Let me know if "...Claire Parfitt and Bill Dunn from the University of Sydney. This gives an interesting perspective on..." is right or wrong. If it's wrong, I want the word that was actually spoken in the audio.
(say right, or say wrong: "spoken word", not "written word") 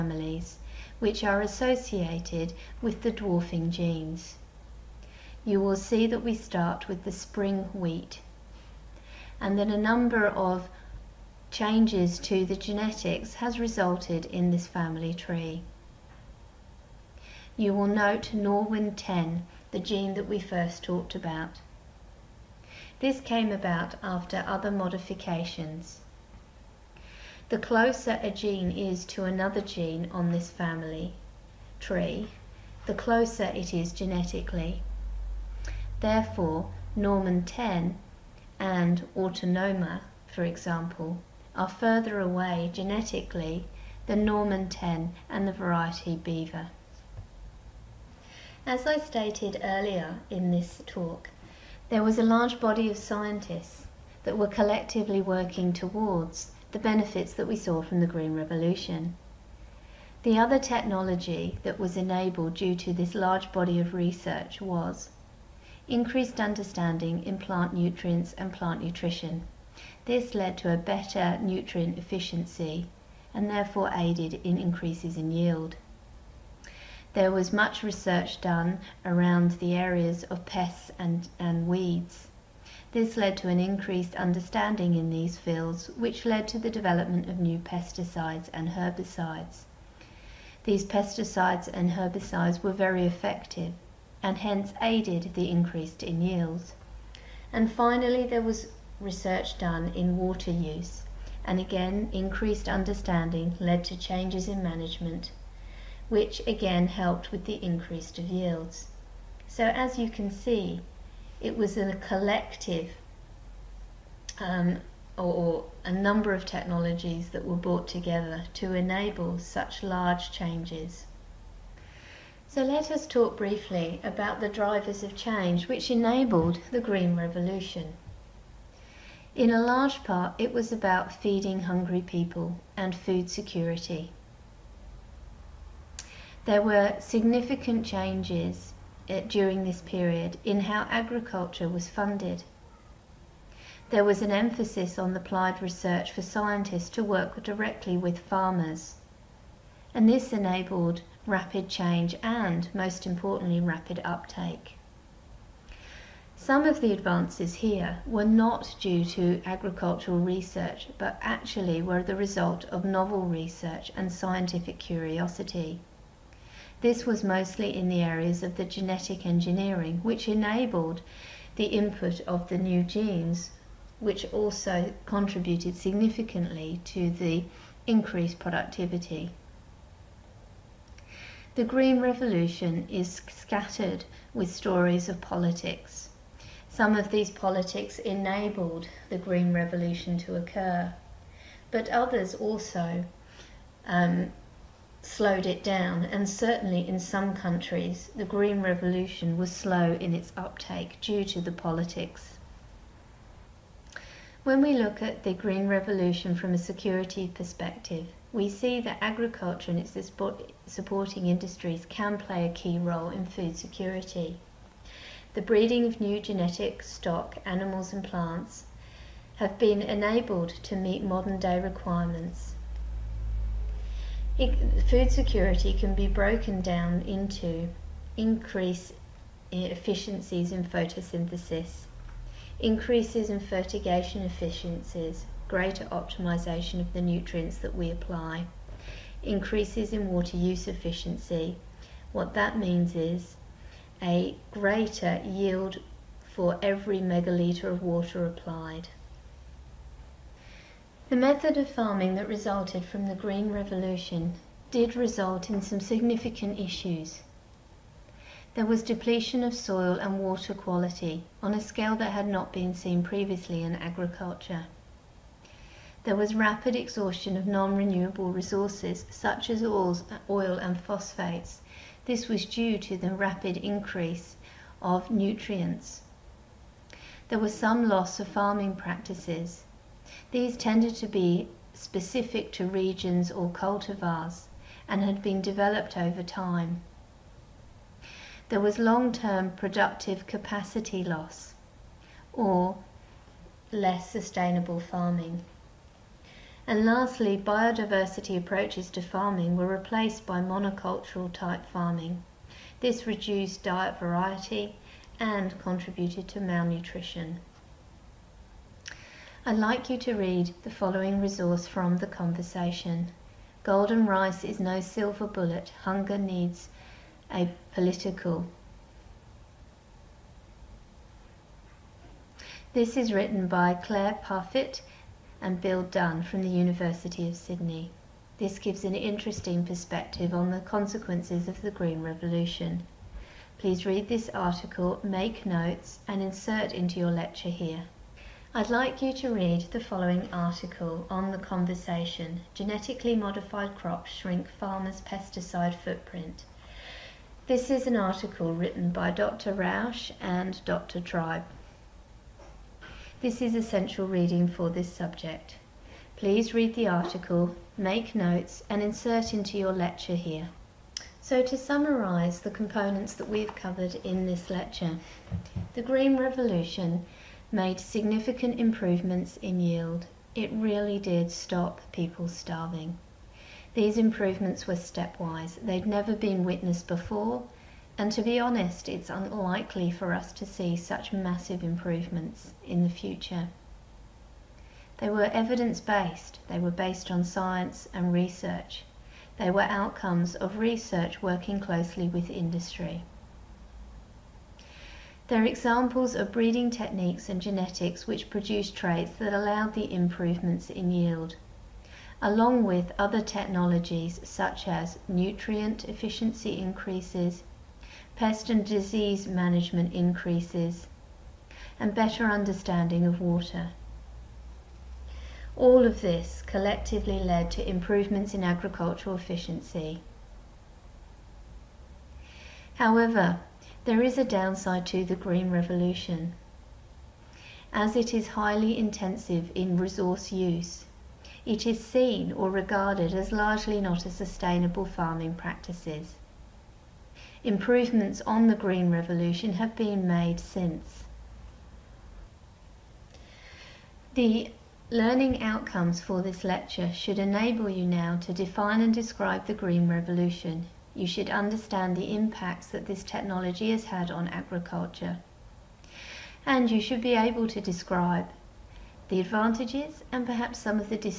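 right.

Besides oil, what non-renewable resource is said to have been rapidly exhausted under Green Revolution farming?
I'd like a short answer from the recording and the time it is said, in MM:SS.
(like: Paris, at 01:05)
Phosphates, at 04:30.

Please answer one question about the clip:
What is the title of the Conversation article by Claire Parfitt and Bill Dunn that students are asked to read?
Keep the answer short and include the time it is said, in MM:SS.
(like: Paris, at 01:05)
Golden Rice is No Silver Bullet, at 05:13.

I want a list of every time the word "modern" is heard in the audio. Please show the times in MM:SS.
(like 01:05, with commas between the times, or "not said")
03:41.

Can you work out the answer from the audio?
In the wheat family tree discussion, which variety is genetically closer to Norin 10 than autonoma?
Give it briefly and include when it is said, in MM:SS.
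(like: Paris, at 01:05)
Beaver, at 00:46.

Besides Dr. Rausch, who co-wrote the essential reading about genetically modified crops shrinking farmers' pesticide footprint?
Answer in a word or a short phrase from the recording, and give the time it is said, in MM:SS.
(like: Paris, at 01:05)
Dr. Tribe, at 05:50.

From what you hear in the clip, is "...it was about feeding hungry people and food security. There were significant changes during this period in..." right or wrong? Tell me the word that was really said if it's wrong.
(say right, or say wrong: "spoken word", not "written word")
right.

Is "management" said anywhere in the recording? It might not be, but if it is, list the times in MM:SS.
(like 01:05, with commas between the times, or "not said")
01:44, 06:49.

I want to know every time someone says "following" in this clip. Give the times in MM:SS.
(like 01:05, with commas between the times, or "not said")
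05:10, 05:39.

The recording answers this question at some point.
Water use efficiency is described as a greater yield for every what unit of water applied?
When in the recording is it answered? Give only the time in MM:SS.
04:06.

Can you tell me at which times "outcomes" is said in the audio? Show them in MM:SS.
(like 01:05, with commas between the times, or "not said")
06:29, 07:25.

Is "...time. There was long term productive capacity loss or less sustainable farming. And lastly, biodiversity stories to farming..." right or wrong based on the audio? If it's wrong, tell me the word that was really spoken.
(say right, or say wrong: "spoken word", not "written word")
wrong: "approaches", not "stories".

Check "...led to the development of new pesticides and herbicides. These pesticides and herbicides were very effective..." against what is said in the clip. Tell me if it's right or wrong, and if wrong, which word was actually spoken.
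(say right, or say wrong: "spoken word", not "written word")
right.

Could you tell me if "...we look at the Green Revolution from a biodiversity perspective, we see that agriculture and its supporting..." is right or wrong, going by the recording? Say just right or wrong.
wrong.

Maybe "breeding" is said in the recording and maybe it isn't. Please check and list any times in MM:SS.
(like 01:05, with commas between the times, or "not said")
03:35, 06:36.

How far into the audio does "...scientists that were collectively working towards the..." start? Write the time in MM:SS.
00:52.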